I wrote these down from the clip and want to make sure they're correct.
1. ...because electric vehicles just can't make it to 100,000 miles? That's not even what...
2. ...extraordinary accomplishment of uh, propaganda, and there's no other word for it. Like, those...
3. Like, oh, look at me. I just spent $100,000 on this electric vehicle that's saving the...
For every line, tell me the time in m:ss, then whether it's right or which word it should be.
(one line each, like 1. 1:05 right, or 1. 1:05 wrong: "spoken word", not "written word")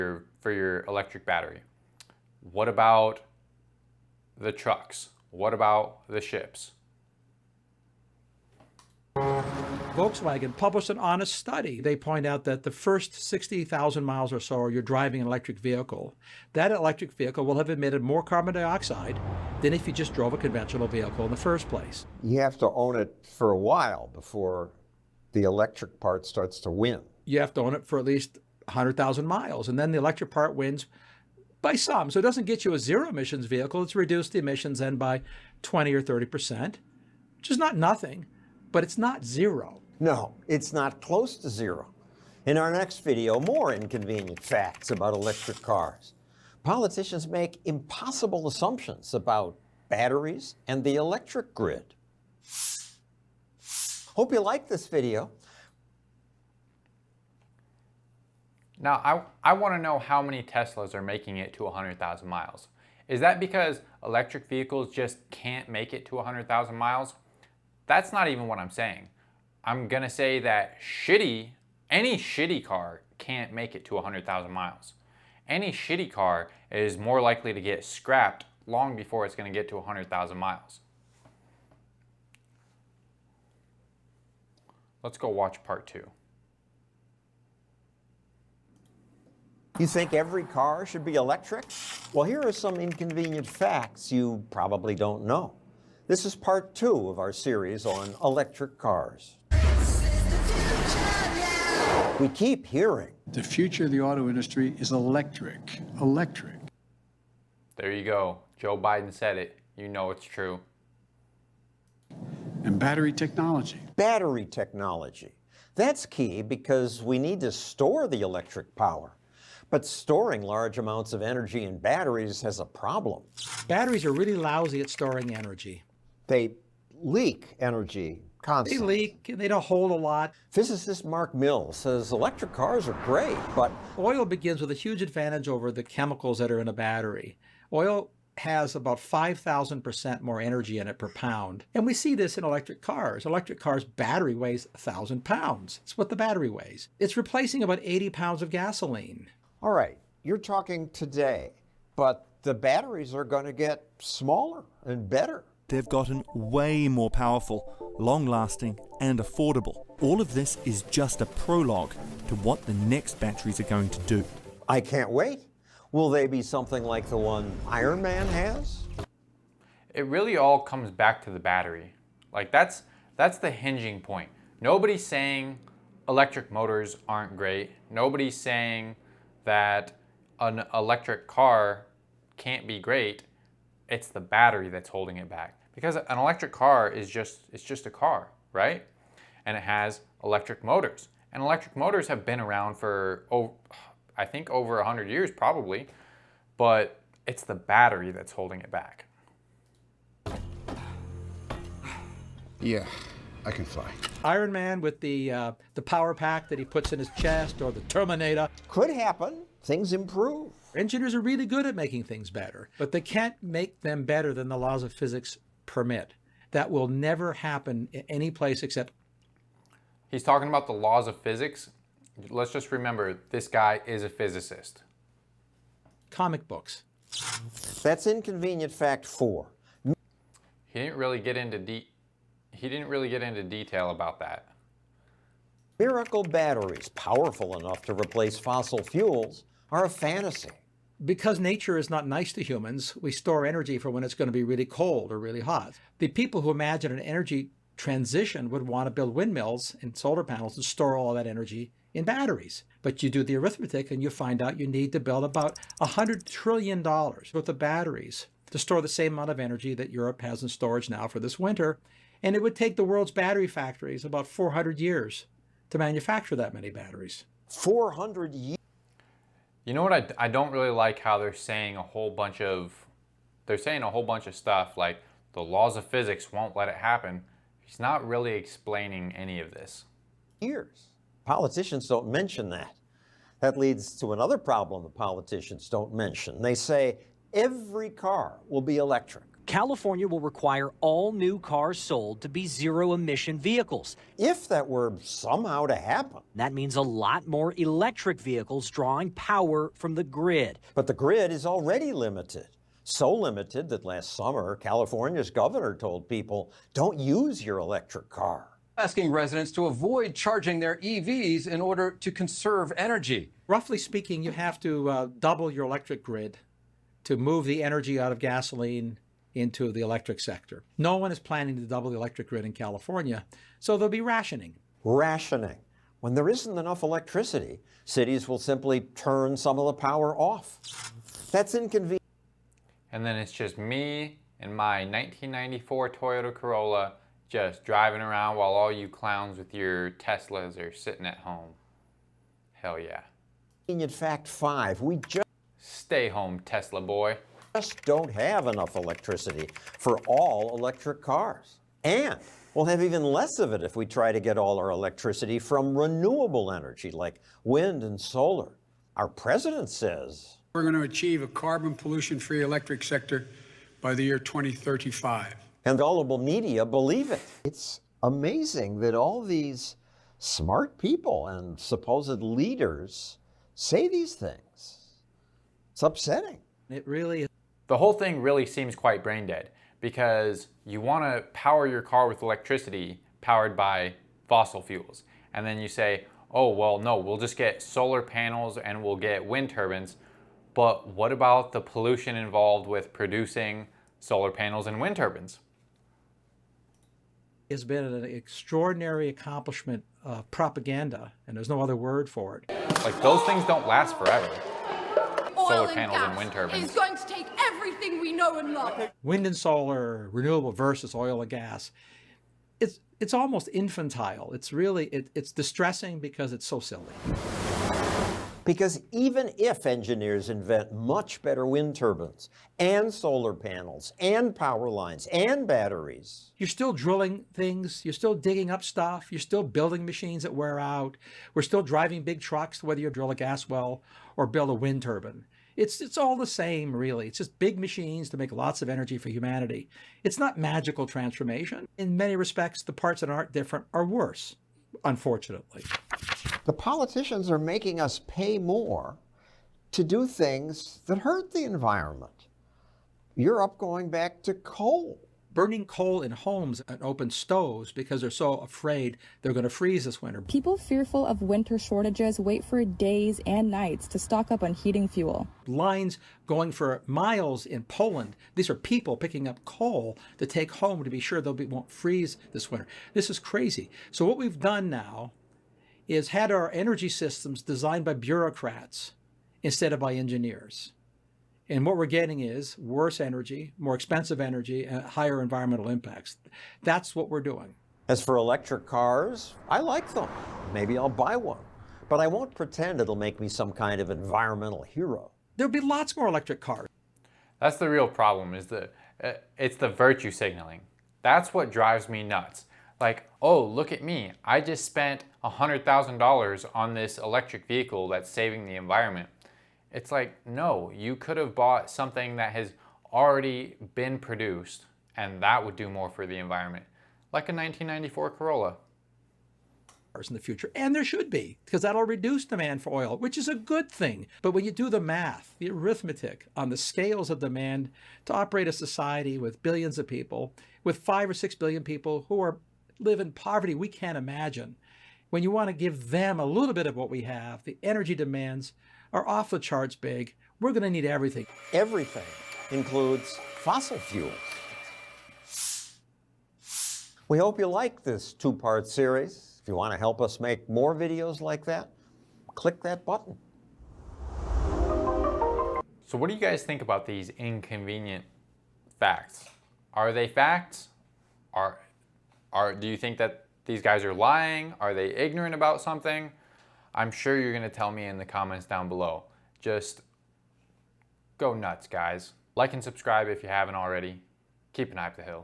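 1. 1:03 right
2. 6:38 right
3. 8:22 right.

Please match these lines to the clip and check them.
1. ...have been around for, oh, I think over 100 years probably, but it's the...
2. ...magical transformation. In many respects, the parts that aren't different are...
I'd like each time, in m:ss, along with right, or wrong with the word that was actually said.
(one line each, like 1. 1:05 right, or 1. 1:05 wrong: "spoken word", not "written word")
1. 3:12 right
2. 7:20 right.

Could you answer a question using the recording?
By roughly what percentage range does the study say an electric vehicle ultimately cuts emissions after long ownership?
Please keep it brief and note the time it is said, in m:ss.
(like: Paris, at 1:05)
20 or 30 percent, at 0:35.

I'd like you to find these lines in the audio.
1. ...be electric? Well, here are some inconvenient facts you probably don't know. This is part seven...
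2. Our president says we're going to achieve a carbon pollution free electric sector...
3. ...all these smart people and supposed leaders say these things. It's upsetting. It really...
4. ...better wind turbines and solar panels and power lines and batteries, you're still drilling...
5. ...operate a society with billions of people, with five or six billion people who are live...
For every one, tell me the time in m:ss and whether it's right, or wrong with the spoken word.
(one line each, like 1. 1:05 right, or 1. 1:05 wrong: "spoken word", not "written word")
1. 1:31 wrong: "two", not "seven"
2. 5:58 right
3. 6:08 right
4. 7:01 right
5. 8:48 right.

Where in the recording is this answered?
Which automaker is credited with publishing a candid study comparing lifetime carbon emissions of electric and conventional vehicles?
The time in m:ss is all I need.
0:09.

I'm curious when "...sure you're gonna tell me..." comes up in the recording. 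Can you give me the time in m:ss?
9:26.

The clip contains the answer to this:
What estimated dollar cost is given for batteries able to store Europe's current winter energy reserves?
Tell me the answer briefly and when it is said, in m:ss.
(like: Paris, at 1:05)
$100 trillion, at 4:15.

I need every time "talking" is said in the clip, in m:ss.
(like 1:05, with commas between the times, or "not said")
2:30, 3:40.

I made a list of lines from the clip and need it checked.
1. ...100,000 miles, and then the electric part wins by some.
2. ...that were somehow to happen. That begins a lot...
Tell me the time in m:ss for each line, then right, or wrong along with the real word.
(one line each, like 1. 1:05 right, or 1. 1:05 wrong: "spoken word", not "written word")
1. 0:28 right
2. 4:54 wrong: "means", not "begins".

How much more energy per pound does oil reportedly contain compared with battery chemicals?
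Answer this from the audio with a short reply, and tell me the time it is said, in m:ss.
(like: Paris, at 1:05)
5,000%, at 2:18.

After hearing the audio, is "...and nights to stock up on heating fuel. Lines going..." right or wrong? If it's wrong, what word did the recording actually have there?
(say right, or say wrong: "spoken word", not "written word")
right.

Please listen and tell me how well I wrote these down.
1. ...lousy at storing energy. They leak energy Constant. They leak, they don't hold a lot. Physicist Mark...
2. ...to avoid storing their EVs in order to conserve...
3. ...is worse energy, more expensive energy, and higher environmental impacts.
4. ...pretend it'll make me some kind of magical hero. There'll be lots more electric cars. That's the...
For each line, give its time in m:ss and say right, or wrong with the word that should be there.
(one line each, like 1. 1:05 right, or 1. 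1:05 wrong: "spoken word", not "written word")
1. 2:04 right
2. 5:09 wrong: "charging", not "storing"
3. 8:02 right
4. 8:12 wrong: "environmental", not "magical".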